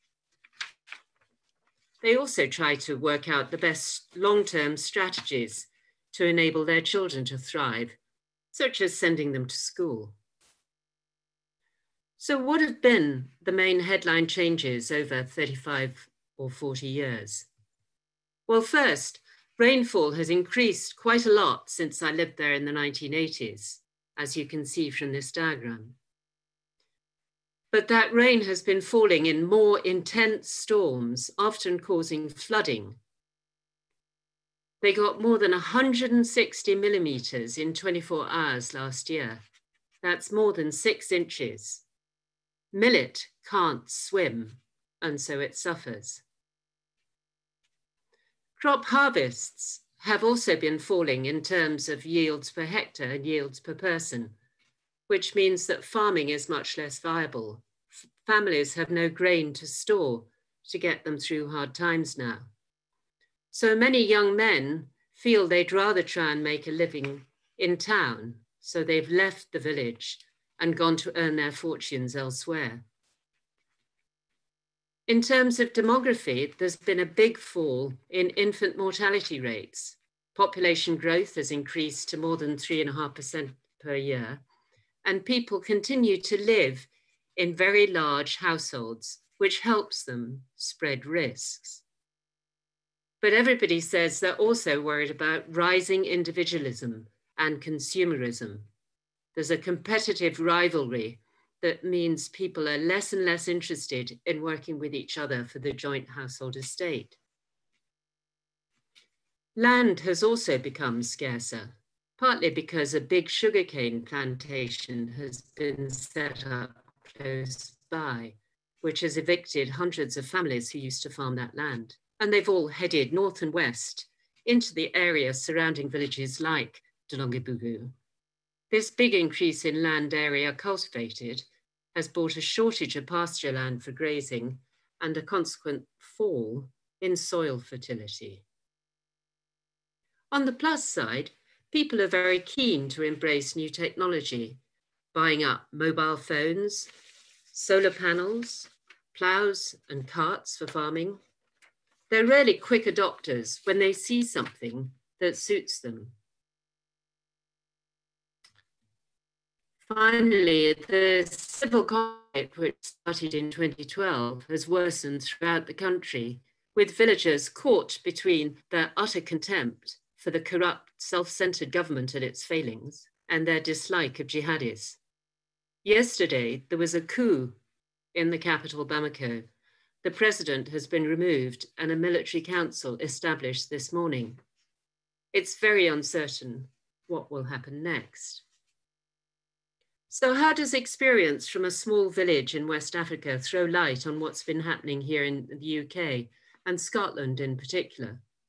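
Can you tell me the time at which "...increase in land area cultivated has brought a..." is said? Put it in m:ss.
2:09.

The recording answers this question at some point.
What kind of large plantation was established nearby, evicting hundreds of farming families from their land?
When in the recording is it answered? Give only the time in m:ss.
1:53.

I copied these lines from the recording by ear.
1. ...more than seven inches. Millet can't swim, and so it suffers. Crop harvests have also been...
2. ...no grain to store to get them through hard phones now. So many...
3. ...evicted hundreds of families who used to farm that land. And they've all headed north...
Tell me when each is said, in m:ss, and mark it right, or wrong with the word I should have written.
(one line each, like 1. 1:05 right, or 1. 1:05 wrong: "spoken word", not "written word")
1. 0:40 wrong: "six", not "seven"
2. 0:58 wrong: "times", not "phones"
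3. 1:59 right.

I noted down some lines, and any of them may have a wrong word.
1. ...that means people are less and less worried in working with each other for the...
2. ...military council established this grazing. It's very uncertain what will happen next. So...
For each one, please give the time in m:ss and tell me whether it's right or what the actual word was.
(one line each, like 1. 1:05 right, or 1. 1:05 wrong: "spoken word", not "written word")
1. 1:41 wrong: "interested", not "worried"
2. 3:01 wrong: "morning", not "grazing".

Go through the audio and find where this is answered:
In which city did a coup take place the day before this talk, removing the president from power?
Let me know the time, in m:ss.
2:58.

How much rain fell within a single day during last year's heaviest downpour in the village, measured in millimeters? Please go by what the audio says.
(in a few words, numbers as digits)
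more than 160 millimeters.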